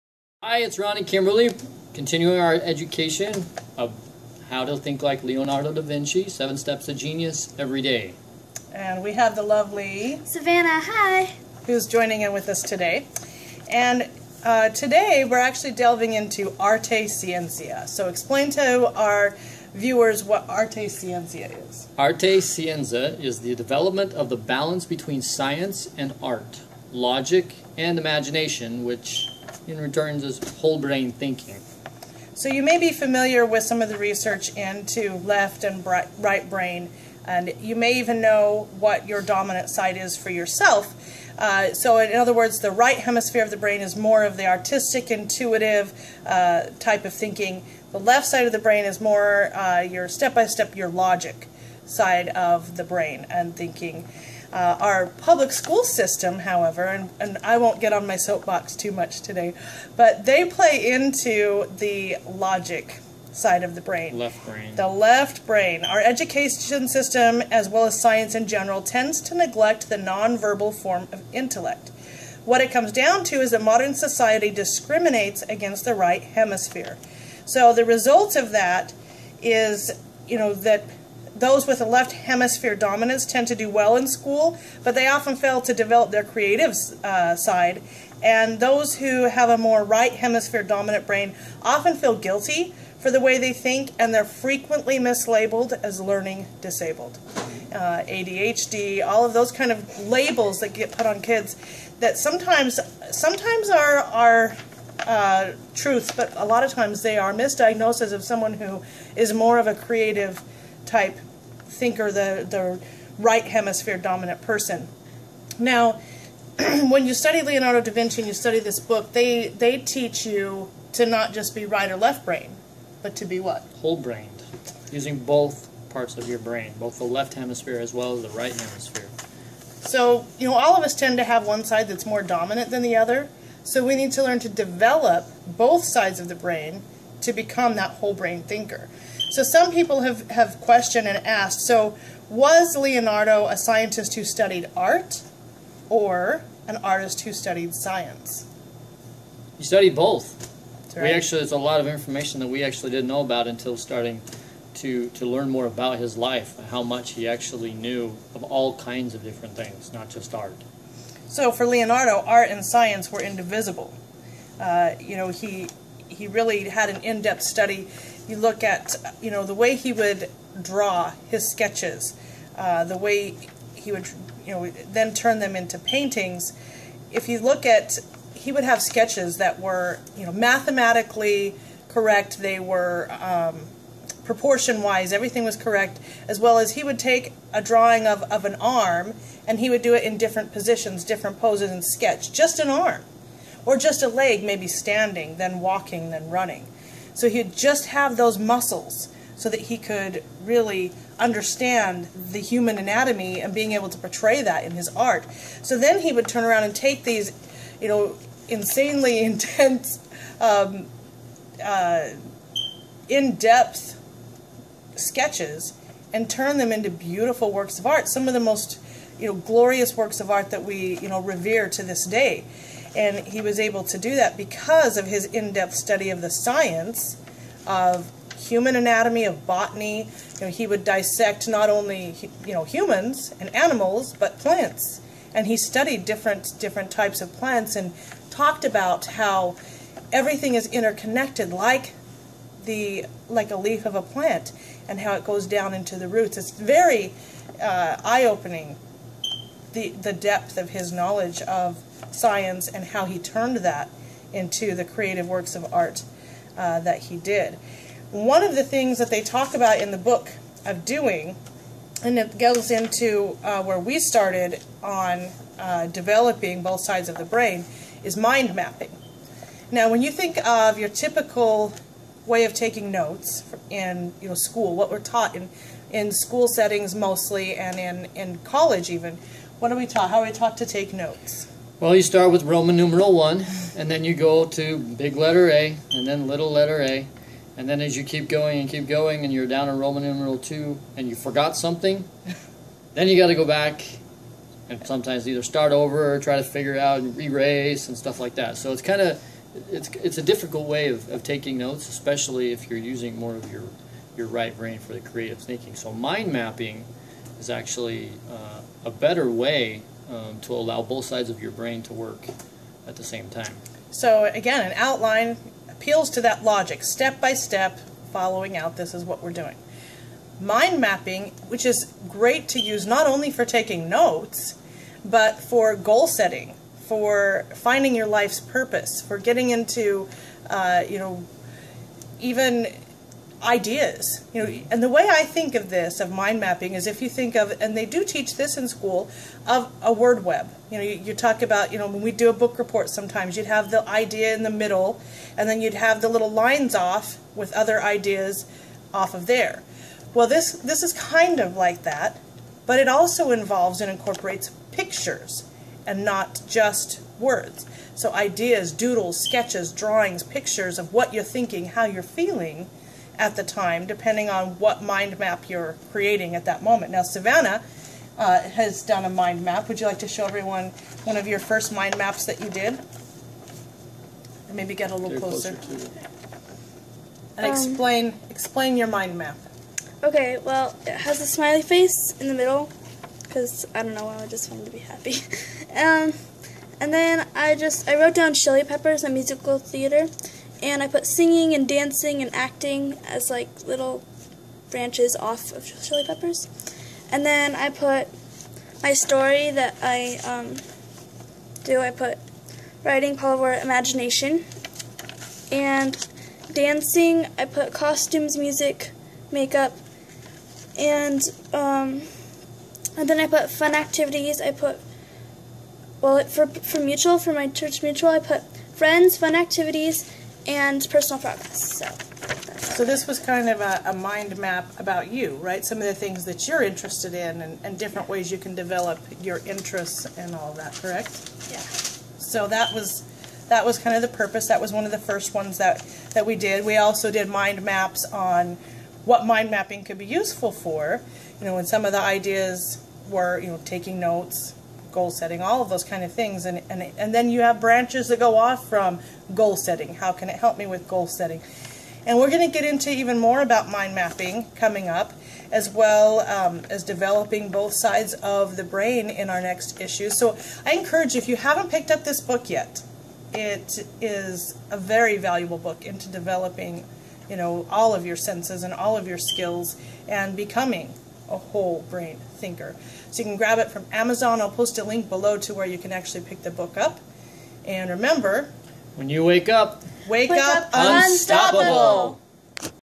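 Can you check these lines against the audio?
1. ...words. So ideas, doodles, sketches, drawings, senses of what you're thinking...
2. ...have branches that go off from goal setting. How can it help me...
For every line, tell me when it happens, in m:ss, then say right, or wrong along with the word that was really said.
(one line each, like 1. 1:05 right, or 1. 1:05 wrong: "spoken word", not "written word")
1. 5:57 wrong: "pictures", not "senses"
2. 7:27 right.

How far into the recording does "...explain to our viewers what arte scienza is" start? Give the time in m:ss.
0:18.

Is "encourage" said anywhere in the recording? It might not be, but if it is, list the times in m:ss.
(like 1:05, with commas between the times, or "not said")
7:40.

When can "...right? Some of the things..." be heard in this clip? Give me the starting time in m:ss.
7:05.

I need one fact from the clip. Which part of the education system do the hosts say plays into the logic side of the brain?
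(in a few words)
public school system.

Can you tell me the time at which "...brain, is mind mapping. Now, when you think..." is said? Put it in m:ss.
4:27.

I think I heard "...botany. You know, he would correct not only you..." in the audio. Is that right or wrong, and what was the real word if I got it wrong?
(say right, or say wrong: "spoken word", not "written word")
wrong: "dissect", not "correct".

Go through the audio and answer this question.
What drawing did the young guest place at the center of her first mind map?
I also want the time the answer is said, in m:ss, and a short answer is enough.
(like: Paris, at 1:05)
a smiley face, at 6:21.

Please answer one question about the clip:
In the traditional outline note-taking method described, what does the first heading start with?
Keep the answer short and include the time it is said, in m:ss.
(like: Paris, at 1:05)
Roman numeral 1, at 4:42.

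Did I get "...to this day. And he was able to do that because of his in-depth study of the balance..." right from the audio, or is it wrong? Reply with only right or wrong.
wrong.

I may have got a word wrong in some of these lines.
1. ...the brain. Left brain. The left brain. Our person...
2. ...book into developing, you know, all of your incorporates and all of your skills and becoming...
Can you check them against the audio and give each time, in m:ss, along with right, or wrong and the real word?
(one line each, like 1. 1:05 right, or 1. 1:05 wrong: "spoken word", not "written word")
1. 1:03 wrong: "education", not "person"
2. 7:45 wrong: "senses", not "incorporates".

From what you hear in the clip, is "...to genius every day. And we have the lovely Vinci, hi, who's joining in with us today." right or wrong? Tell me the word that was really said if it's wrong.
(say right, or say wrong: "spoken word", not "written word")
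wrong: "Savannah", not "Vinci".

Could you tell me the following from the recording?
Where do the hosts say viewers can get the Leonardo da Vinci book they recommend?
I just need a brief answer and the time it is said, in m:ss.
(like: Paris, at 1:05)
Amazon, at 7:53.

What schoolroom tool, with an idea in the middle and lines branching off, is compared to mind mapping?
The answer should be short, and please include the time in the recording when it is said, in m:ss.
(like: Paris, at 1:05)
word web, at 5:39.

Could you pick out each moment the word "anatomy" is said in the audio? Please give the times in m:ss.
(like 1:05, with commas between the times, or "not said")
3:22, 3:48.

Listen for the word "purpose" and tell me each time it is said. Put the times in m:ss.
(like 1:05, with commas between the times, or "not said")
5:28, 7:14.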